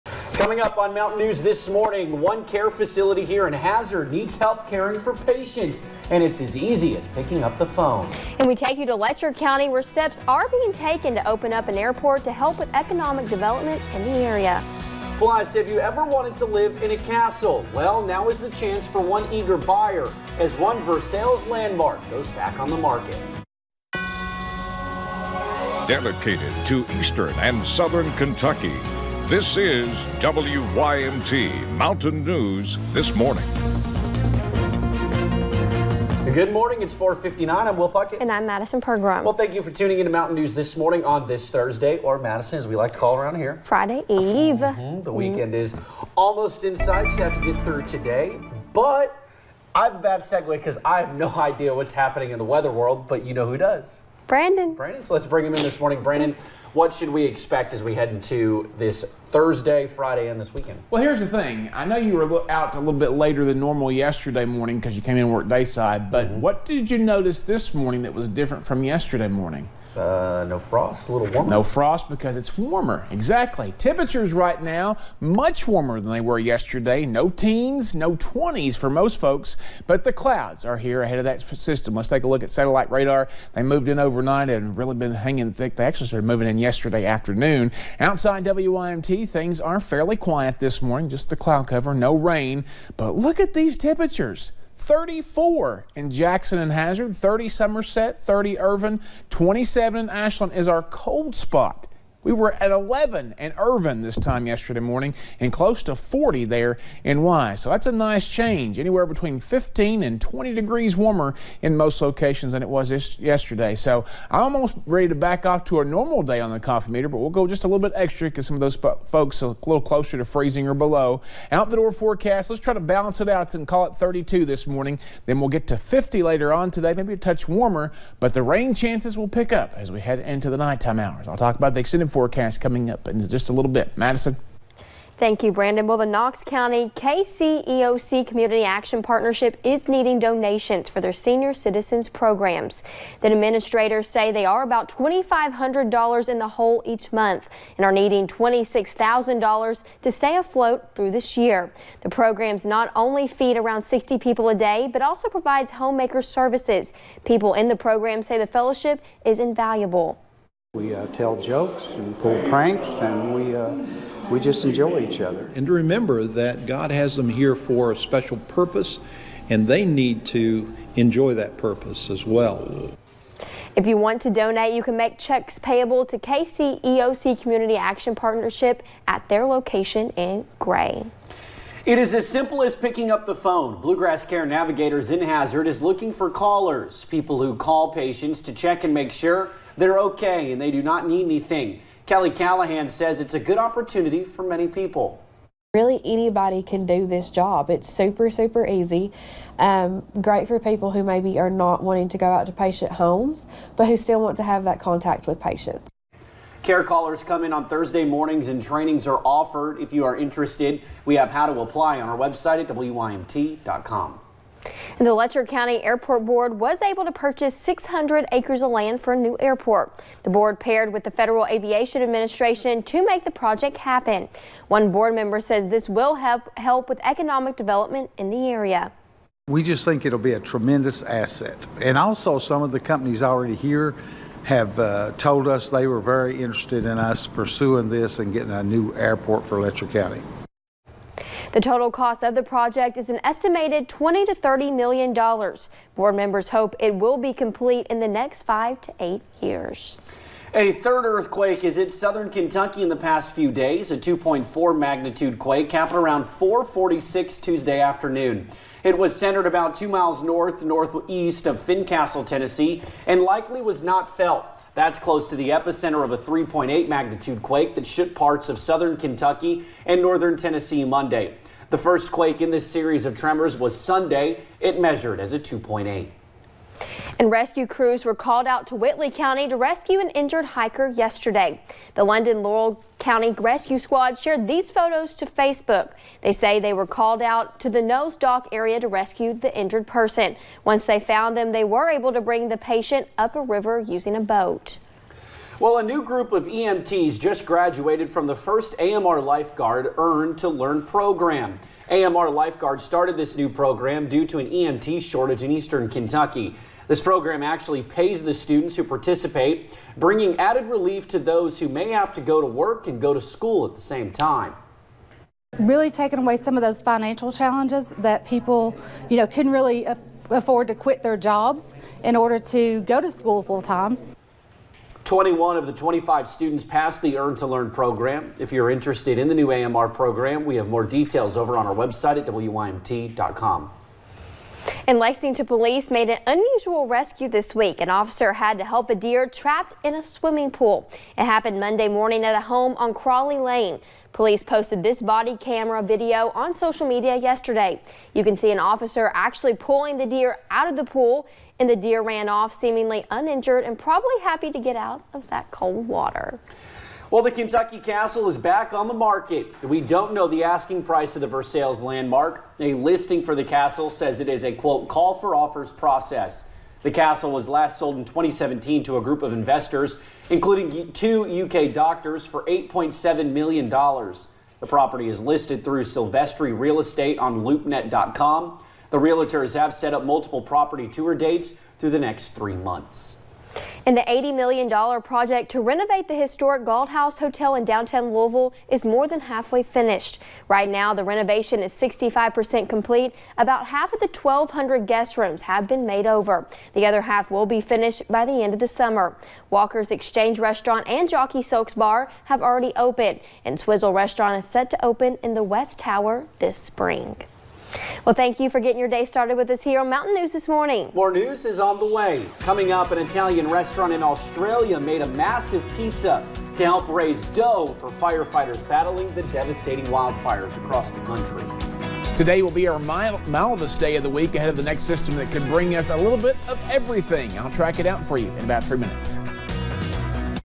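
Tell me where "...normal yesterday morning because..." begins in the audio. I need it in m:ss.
1:03.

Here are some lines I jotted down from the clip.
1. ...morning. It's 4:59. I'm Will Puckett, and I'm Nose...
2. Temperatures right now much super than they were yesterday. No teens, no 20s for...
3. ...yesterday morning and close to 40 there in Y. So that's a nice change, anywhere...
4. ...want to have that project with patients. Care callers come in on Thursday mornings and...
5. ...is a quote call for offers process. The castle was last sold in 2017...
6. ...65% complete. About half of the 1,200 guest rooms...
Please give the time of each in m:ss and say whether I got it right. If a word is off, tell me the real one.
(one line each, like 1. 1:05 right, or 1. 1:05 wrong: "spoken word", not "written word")
1. 0:36 wrong: "Madison", not "Nose"
2. 1:13 wrong: "warmer", not "super"
3. 1:44 right
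4. 3:24 wrong: "contact", not "project"
5. 6:04 right
6. 6:31 right.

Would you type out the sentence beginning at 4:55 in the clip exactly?
Well, a new group of EMTs just graduated from the first AMR Lifeguard Earn to Learn program.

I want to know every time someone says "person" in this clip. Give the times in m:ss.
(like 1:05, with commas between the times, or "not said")
4:49.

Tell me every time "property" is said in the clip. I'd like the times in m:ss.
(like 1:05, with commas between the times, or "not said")
6:14, 6:20.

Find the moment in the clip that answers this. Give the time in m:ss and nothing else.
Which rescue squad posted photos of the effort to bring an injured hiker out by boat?
4:42.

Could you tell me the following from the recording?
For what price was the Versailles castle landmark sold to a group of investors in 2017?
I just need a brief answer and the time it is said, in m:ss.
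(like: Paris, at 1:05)
$8.7 million, at 6:12.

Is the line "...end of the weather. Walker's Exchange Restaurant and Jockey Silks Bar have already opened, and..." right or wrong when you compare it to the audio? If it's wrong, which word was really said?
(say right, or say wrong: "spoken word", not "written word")
wrong: "summer", not "weather".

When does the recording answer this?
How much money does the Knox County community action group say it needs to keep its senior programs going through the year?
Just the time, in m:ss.
2:28.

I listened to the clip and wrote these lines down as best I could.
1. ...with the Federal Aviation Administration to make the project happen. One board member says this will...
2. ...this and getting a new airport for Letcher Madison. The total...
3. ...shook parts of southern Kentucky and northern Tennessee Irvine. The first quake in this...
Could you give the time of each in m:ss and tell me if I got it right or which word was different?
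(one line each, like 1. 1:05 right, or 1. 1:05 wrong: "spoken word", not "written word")
1. 3:40 right
2. 3:57 wrong: "County", not "Madison"
3. 4:27 wrong: "Monday", not "Irvine".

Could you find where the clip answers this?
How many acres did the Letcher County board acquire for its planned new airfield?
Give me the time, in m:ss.
3:37.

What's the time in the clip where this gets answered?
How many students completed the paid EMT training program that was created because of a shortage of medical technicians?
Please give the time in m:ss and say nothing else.
5:25.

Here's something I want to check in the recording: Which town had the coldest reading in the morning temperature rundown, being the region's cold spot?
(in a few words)
Ashland.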